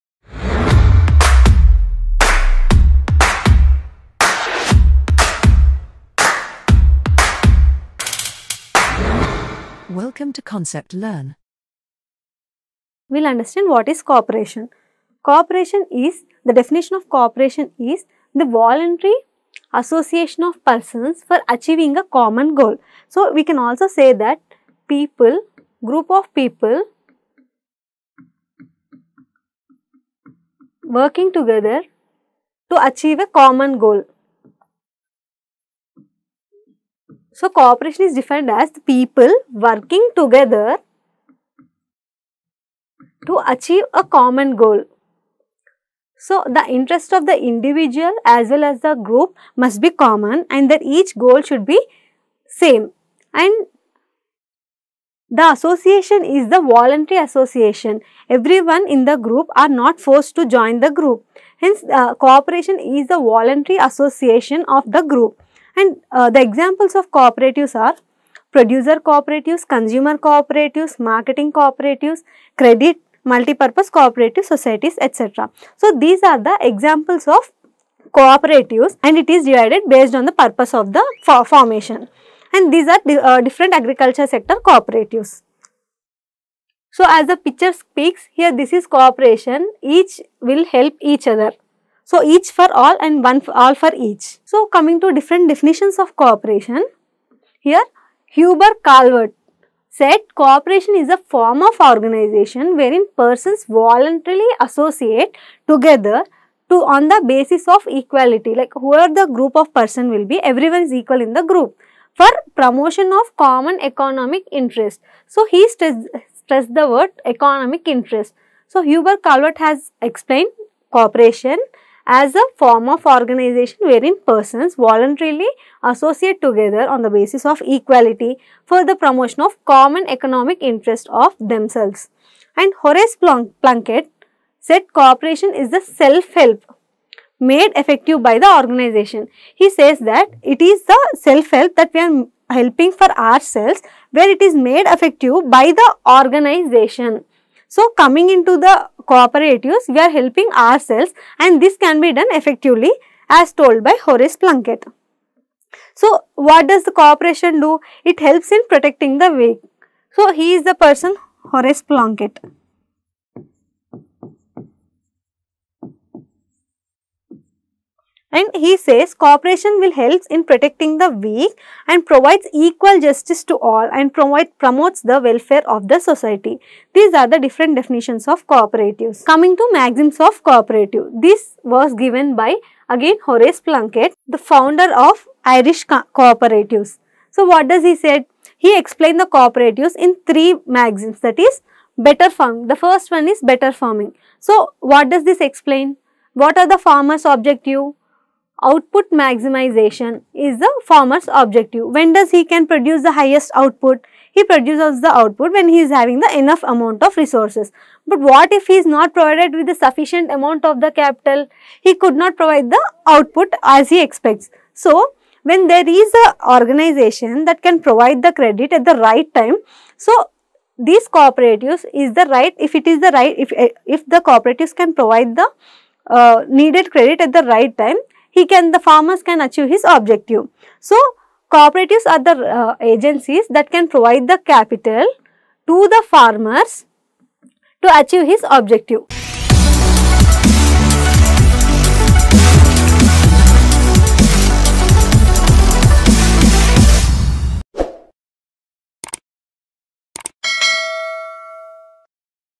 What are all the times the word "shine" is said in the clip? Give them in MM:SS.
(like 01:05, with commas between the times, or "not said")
not said.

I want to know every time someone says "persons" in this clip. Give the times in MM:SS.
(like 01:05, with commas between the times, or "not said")
00:20, 01:43, 01:49, 02:04, 02:40.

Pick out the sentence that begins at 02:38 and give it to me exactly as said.
It helps in protecting the wake.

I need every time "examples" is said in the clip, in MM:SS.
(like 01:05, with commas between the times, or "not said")
01:06, 01:16.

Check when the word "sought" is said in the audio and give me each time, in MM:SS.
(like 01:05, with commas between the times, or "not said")
not said.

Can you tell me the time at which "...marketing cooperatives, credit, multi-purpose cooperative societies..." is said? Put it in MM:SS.
01:10.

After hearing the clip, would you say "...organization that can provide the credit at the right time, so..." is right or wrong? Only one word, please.
right.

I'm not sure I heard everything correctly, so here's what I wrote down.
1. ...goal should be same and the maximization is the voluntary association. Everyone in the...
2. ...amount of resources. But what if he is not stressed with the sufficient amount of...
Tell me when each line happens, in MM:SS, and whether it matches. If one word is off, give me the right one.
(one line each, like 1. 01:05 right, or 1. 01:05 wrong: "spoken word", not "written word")
1. 00:51 wrong: "association", not "maximization"
2. 03:26 wrong: "provided", not "stressed".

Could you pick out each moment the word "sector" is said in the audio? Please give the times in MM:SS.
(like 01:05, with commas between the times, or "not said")
01:24.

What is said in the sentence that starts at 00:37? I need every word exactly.
So, cooperation is defined as the people working together to achieve a common goal.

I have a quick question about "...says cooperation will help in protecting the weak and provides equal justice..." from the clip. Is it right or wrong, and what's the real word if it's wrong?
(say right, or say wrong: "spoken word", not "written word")
right.